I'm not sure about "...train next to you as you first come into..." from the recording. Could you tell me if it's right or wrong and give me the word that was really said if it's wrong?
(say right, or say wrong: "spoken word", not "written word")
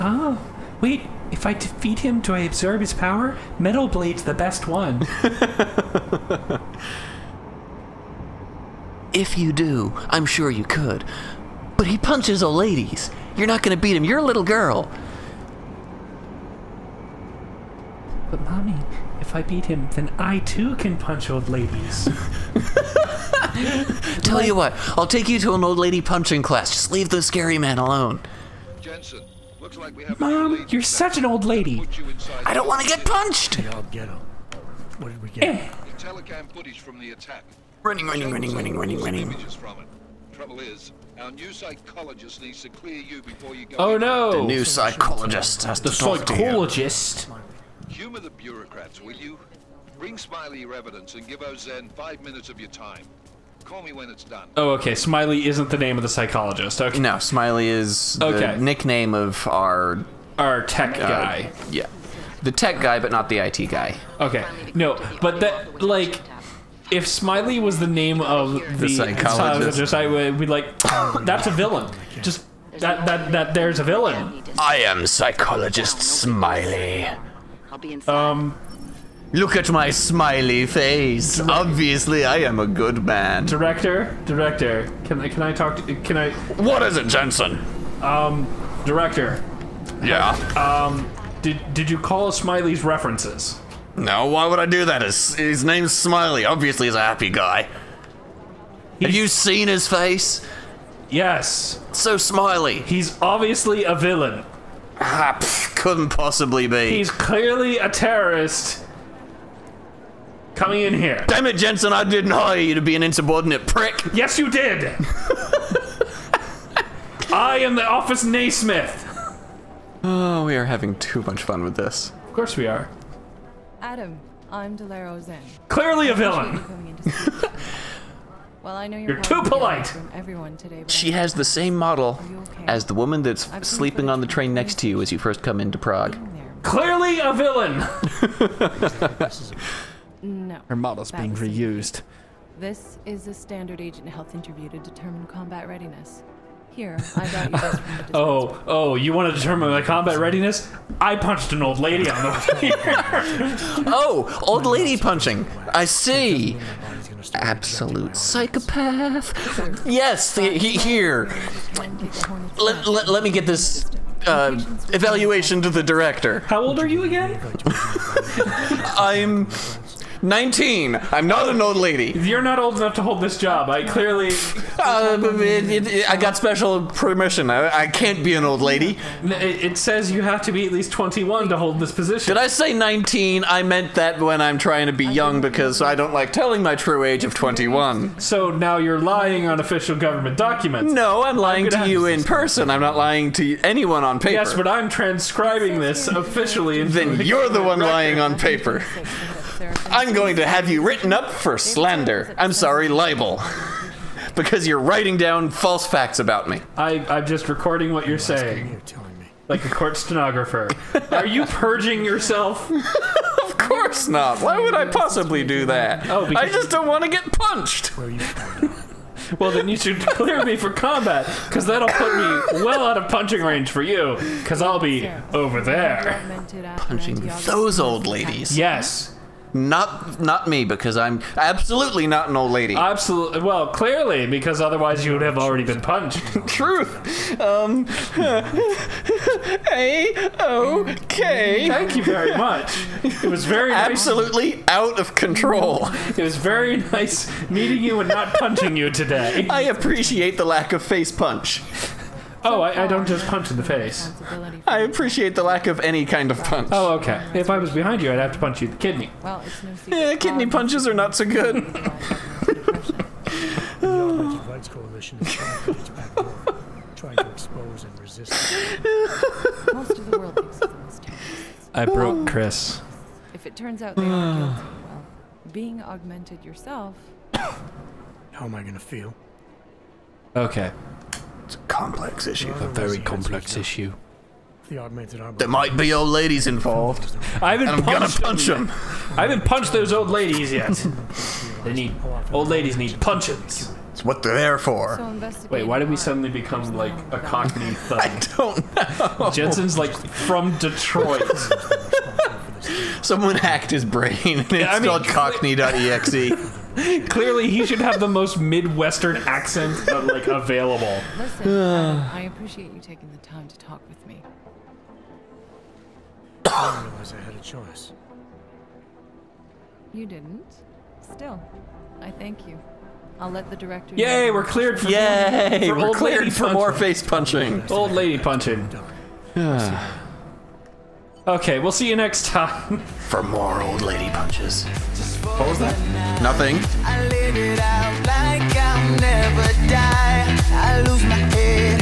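right.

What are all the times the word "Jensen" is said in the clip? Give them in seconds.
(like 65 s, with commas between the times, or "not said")
28 s, 87 s, 111 s, 299 s.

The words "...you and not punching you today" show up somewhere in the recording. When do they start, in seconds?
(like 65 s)
247 s.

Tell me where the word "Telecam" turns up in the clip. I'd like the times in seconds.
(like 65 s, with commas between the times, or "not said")
35 s.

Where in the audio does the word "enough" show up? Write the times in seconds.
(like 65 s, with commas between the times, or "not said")
172 s.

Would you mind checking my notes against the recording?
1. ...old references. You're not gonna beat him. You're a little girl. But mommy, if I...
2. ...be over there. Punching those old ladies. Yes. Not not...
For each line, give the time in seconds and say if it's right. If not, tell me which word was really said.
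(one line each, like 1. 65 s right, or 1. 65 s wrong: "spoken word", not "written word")
1. 12 s wrong: "ladies", not "references"
2. 224 s right.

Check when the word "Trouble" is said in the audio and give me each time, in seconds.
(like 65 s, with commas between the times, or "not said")
40 s.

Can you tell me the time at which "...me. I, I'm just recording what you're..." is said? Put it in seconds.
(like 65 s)
206 s.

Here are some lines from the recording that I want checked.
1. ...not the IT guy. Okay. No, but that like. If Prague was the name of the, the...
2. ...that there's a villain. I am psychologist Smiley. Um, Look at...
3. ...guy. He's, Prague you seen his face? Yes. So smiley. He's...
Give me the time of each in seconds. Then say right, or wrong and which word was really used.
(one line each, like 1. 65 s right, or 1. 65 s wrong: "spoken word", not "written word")
1. 63 s wrong: "Smiley", not "Prague"
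2. 73 s right
3. 97 s wrong: "Have", not "Prague".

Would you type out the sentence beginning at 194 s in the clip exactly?
Yes, but I'm transcribing this officially.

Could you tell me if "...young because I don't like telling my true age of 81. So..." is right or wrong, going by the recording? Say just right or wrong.
wrong.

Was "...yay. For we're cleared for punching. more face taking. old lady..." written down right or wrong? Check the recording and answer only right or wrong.
wrong.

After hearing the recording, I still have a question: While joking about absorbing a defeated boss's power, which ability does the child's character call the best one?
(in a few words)
Metal Blade.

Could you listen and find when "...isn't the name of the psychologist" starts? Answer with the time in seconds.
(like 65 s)
55 s.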